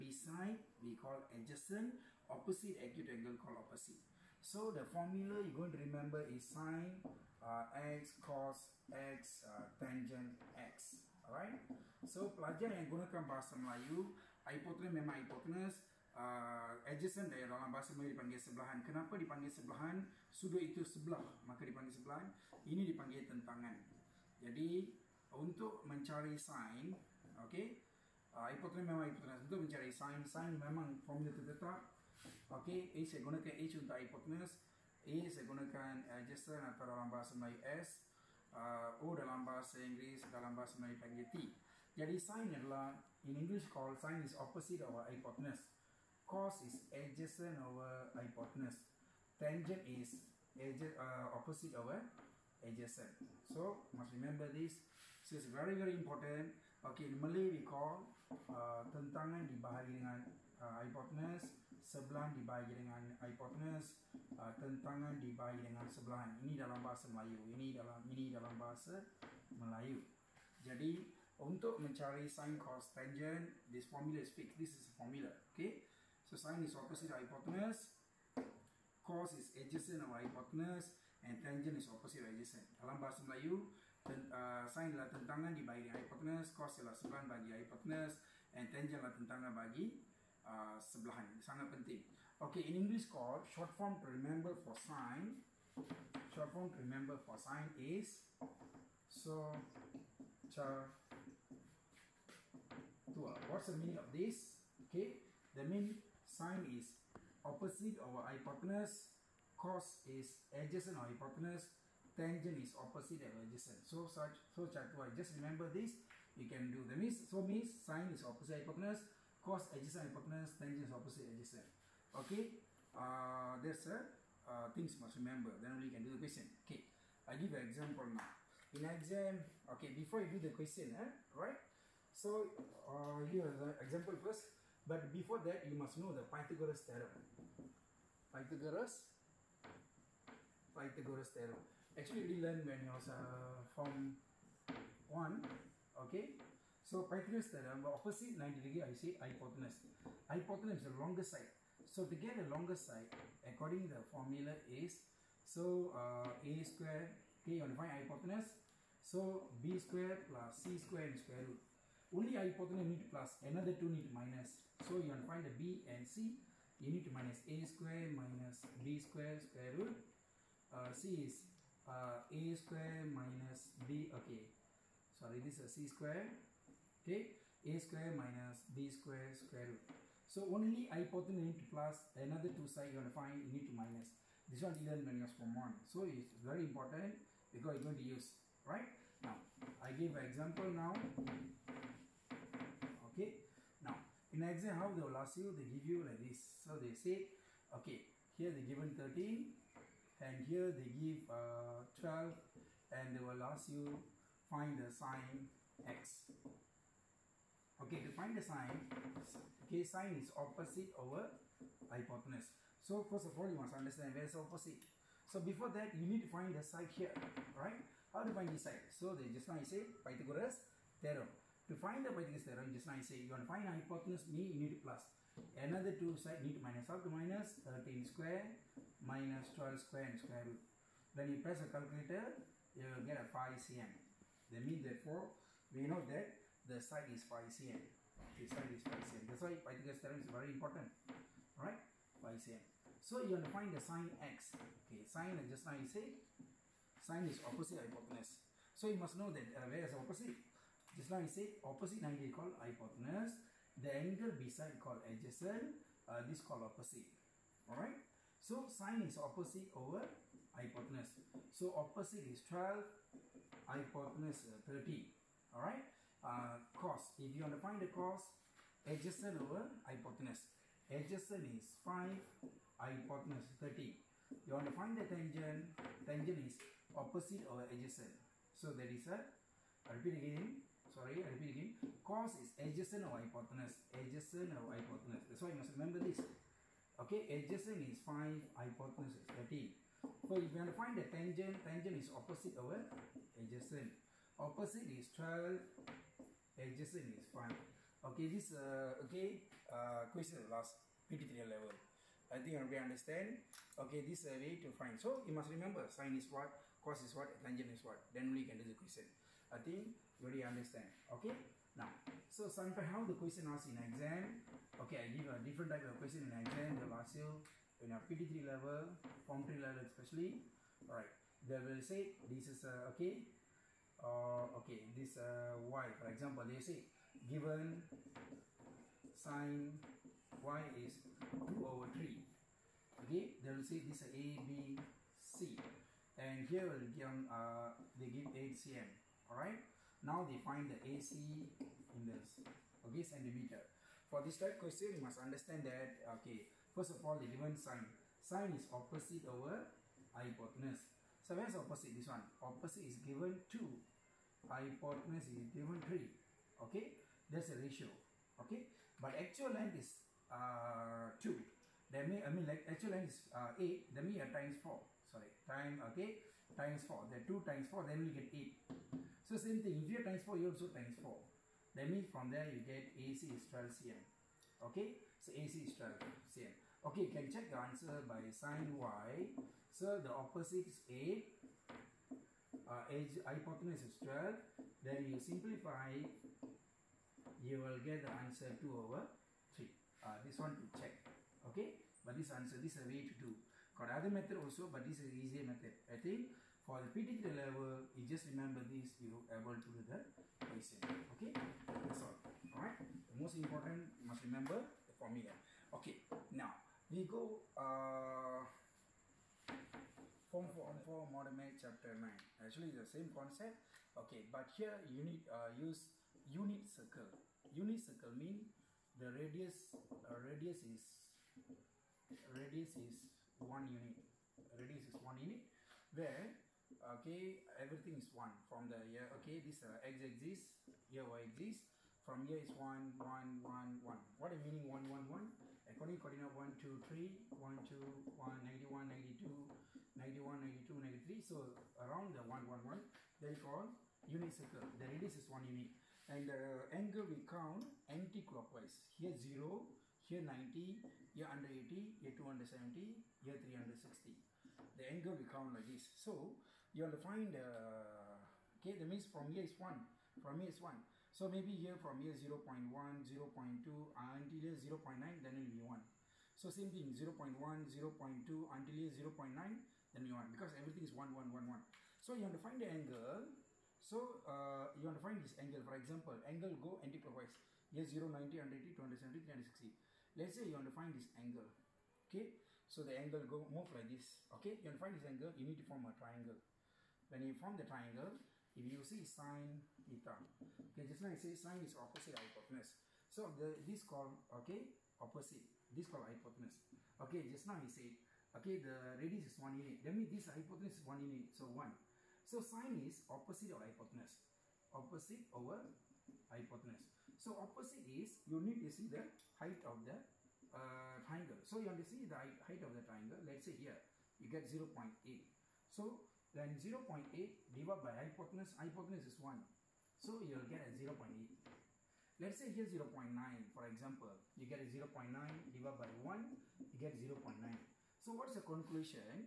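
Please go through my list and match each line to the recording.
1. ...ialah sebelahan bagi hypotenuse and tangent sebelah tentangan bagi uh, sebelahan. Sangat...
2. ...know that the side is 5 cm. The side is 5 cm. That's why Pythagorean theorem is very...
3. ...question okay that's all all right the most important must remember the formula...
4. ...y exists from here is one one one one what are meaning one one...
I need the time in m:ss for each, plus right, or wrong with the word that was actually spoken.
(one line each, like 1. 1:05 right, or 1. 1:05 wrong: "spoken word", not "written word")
1. 1:26 wrong: "adalah", not "sebelah"
2. 3:55 right
3. 6:40 right
4. 7:11 right.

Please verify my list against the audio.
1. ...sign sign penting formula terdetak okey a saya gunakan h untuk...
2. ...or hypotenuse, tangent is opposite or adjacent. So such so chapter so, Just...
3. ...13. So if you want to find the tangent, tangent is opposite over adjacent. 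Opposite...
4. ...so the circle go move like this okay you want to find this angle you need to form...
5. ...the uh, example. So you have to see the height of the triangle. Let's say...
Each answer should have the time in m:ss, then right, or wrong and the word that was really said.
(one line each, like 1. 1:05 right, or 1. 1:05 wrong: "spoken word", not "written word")
1. 0:29 wrong: "memang", not "penting"
2. 1:50 right
3. 4:49 right
4. 8:02 wrong: "angle", not "circle"
5. 8:29 wrong: "triangle", not "example".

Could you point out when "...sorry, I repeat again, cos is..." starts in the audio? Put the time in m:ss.
4:40.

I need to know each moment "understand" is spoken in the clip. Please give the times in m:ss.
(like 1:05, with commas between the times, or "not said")
3:33, 5:02, 5:10, 5:45.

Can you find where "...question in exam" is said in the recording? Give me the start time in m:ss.
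5:16.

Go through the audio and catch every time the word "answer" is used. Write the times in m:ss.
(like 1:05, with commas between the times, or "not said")
6:17, 6:28, 6:32.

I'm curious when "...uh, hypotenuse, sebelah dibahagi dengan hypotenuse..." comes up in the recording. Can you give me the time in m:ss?
1:00.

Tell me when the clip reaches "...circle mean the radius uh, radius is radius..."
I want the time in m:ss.
6:57.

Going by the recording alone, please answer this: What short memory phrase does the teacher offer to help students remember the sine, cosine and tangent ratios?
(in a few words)
so char tua.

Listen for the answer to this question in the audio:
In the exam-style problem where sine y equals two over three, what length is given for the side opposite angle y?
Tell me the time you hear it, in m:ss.
5:38.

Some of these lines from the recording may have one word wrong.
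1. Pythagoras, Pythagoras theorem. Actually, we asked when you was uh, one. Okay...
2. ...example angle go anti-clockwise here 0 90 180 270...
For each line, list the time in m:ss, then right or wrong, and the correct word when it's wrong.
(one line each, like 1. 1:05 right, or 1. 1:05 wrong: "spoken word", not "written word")
1. 2:18 wrong: "learned", not "asked"
2. 7:55 right.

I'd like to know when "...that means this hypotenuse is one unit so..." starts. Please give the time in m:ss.
8:19.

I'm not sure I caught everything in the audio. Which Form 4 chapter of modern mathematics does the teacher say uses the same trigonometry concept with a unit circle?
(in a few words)
chapter 9.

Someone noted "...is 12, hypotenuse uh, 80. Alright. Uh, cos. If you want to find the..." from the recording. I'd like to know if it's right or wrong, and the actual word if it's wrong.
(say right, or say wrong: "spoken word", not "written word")
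wrong: "30", not "80".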